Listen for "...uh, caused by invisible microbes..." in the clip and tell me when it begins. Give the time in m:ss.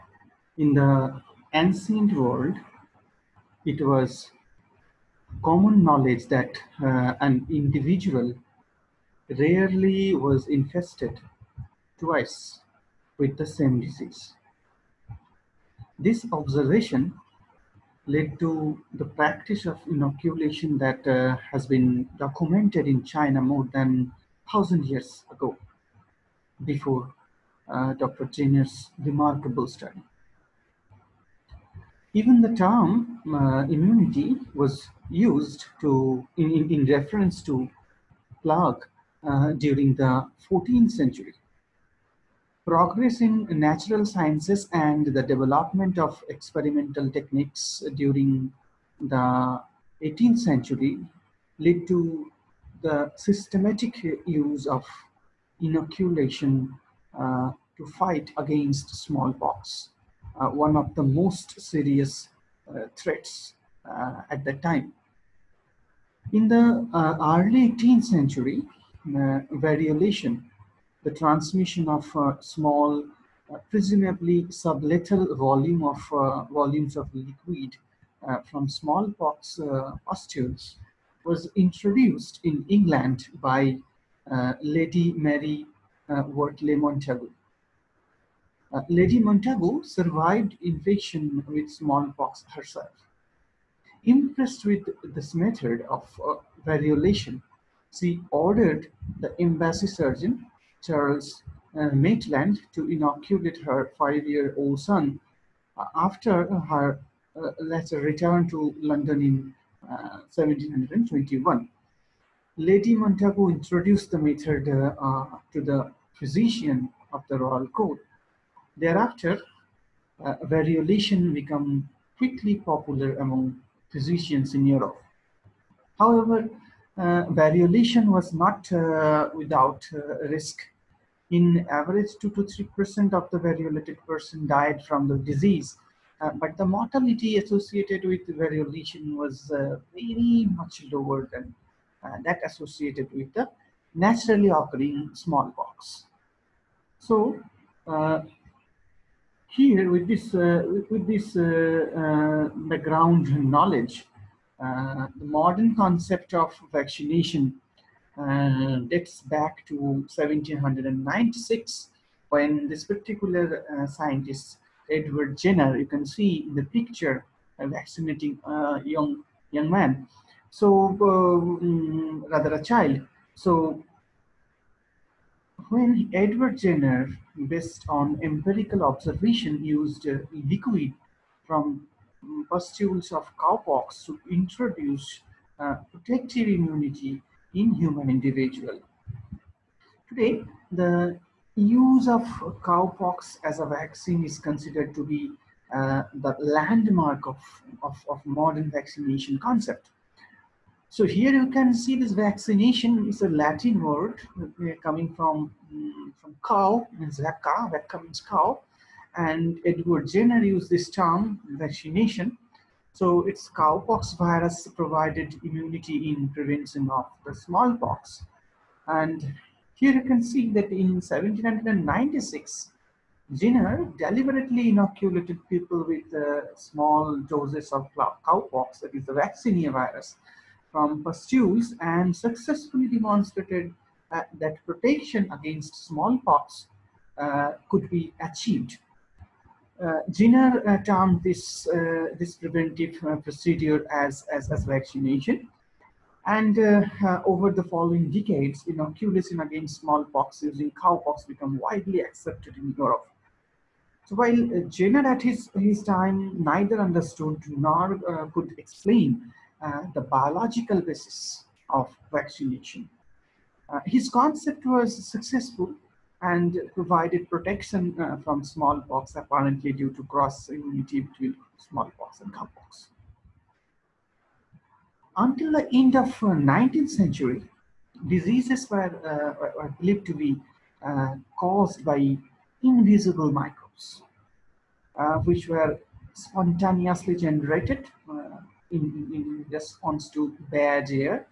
4:40.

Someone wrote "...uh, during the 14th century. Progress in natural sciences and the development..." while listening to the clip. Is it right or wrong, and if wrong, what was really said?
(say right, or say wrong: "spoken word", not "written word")
right.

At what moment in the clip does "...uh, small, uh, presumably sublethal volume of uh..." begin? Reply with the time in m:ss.
1:12.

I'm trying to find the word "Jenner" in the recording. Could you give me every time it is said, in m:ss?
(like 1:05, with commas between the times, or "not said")
0:28, 2:45, 2:56, 3:30, 3:43, 4:00, 4:14.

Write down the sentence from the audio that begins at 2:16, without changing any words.
Uh, but the mortality associated with variolation was uh, very much lower than uh, that associated with the naturally occurring smallpox.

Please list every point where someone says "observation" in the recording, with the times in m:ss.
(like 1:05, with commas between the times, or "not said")
0:16, 2:58.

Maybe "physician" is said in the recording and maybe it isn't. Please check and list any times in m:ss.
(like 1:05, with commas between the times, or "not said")
1:56, 2:03.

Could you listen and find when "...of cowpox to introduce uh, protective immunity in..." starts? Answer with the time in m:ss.
3:03.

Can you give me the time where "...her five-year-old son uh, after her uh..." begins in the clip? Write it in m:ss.
1:43.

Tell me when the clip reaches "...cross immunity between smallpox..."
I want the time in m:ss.
4:30.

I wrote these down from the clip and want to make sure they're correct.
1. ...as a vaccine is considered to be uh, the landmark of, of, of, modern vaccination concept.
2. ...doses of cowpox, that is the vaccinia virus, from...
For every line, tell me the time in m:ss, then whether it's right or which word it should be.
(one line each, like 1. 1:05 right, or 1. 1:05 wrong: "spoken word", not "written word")
1. 3:13 right
2. 3:47 right.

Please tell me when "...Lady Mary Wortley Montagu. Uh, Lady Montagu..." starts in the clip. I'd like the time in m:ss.
1:24.